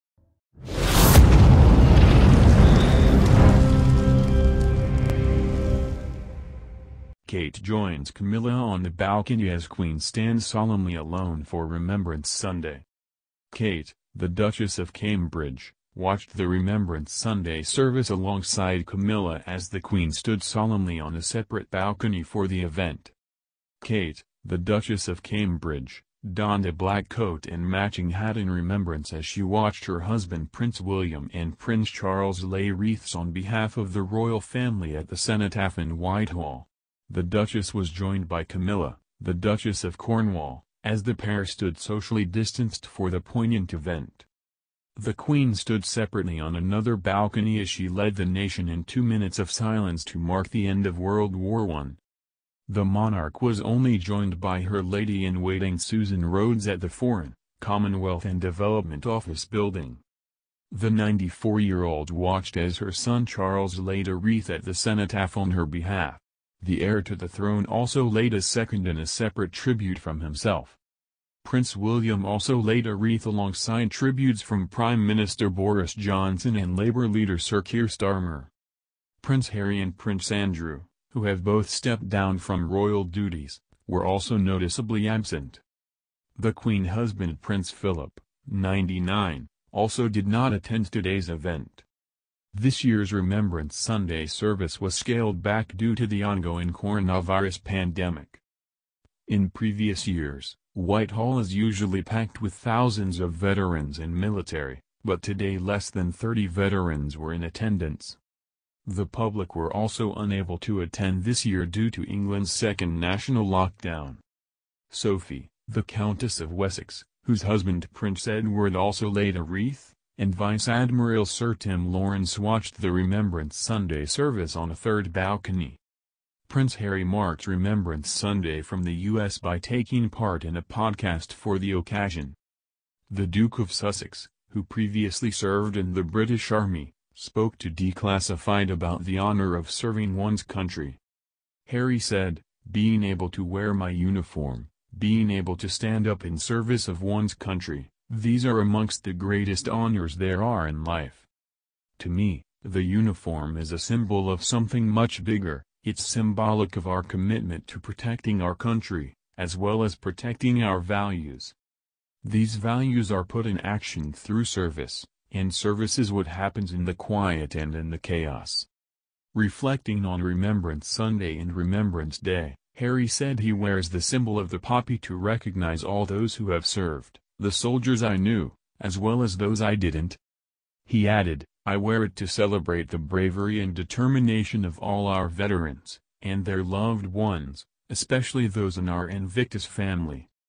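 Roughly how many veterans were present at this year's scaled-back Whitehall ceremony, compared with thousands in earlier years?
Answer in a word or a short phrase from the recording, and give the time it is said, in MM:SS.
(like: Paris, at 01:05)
less than 30, at 01:45.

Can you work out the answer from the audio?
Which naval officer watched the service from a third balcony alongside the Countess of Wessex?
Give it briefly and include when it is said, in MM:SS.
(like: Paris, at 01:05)
Sir Tim Laurence, at 02:01.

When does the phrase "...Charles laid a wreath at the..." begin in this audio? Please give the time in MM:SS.
01:03.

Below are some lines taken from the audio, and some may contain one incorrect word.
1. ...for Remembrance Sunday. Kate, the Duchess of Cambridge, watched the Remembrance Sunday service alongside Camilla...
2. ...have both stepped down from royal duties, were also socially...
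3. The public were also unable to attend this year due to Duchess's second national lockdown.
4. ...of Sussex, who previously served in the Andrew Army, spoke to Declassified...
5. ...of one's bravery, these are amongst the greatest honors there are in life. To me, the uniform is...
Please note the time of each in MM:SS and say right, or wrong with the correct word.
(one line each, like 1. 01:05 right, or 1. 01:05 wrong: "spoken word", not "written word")
1. 00:11 right
2. 01:21 wrong: "noticeably", not "socially"
3. 01:48 wrong: "England", not "Duchess"
4. 02:13 wrong: "British", not "Andrew"
5. 02:26 wrong: "country", not "bravery".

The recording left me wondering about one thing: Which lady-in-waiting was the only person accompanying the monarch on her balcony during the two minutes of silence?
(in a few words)
Susan Rhodes.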